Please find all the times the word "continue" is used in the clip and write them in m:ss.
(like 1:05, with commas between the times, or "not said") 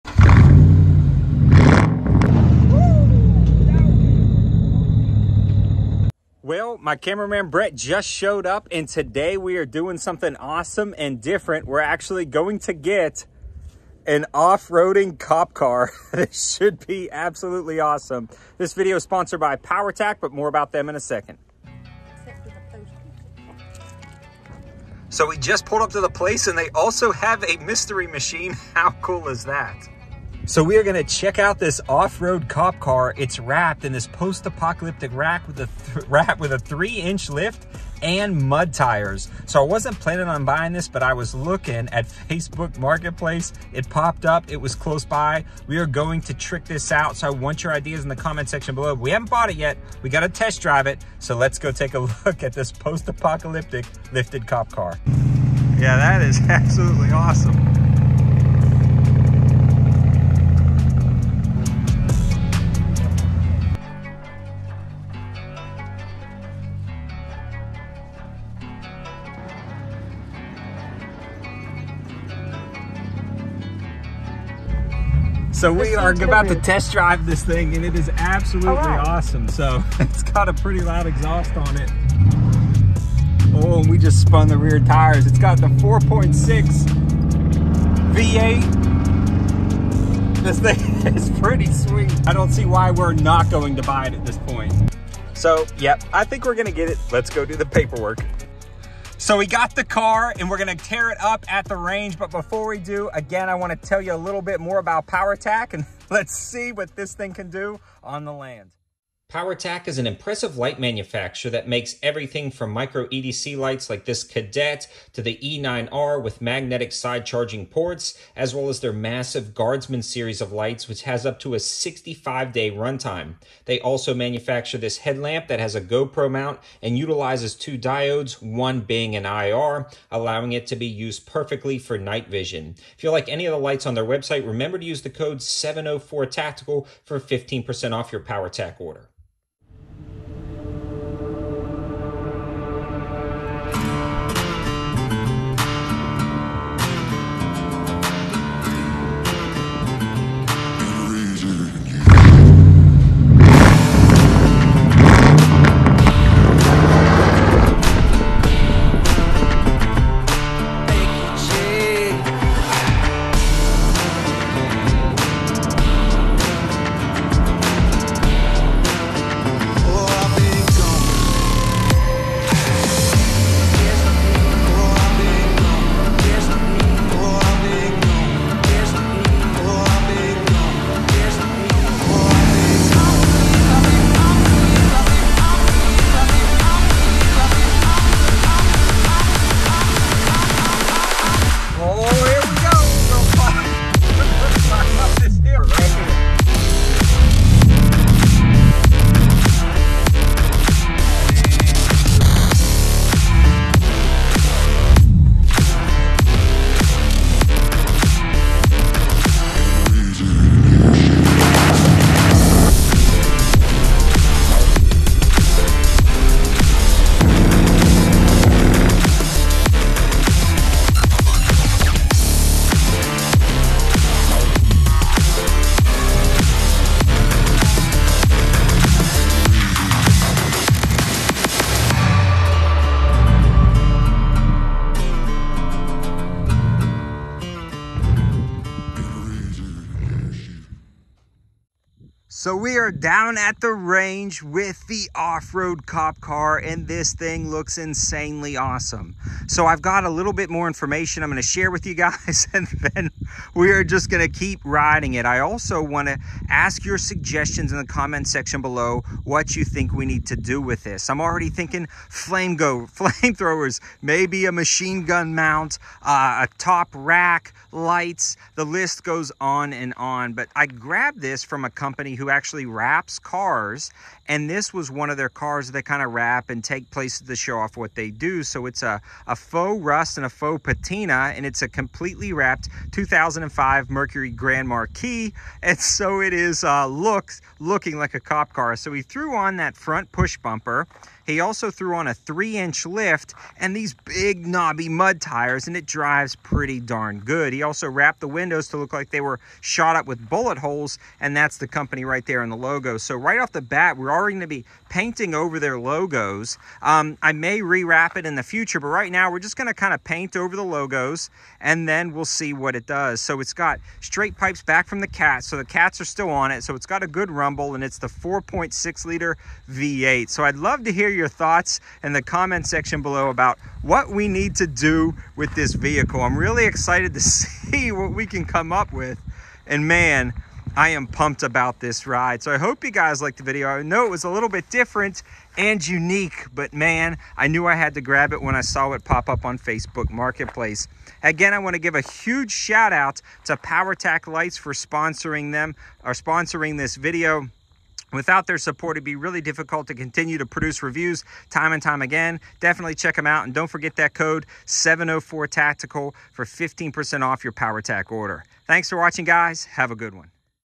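5:49.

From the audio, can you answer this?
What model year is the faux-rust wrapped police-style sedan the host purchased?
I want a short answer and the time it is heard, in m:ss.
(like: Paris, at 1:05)
2005, at 4:42.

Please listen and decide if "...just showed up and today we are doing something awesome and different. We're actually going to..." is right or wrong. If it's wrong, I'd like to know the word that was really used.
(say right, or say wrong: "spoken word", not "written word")
right.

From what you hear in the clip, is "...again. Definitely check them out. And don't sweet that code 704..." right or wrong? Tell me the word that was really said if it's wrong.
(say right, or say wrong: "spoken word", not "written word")
wrong: "forget", not "sweet".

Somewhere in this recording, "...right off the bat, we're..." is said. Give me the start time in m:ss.
5:03.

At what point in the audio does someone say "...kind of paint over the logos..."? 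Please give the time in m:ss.
5:09.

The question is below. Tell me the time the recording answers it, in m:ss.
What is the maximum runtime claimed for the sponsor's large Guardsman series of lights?
2:01.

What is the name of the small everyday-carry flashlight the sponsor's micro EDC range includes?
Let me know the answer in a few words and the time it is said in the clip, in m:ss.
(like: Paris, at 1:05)
Cadet, at 1:54.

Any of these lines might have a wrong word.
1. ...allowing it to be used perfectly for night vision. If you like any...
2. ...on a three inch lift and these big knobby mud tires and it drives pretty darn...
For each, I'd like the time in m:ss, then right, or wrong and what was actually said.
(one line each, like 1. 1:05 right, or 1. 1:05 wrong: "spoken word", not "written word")
1. 2:10 right
2. 4:51 right.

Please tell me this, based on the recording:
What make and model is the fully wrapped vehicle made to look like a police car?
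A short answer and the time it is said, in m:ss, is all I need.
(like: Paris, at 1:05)
Mercury Grand Marquis, at 4:43.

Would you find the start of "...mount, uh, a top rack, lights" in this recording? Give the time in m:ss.
4:25.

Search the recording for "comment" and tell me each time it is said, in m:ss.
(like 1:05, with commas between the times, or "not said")
0:48, 4:17, 5:22.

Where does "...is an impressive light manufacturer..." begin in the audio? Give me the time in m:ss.
1:49.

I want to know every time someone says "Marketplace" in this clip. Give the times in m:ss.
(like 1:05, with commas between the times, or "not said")
0:42, 5:40.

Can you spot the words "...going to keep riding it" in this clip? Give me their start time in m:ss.
4:14.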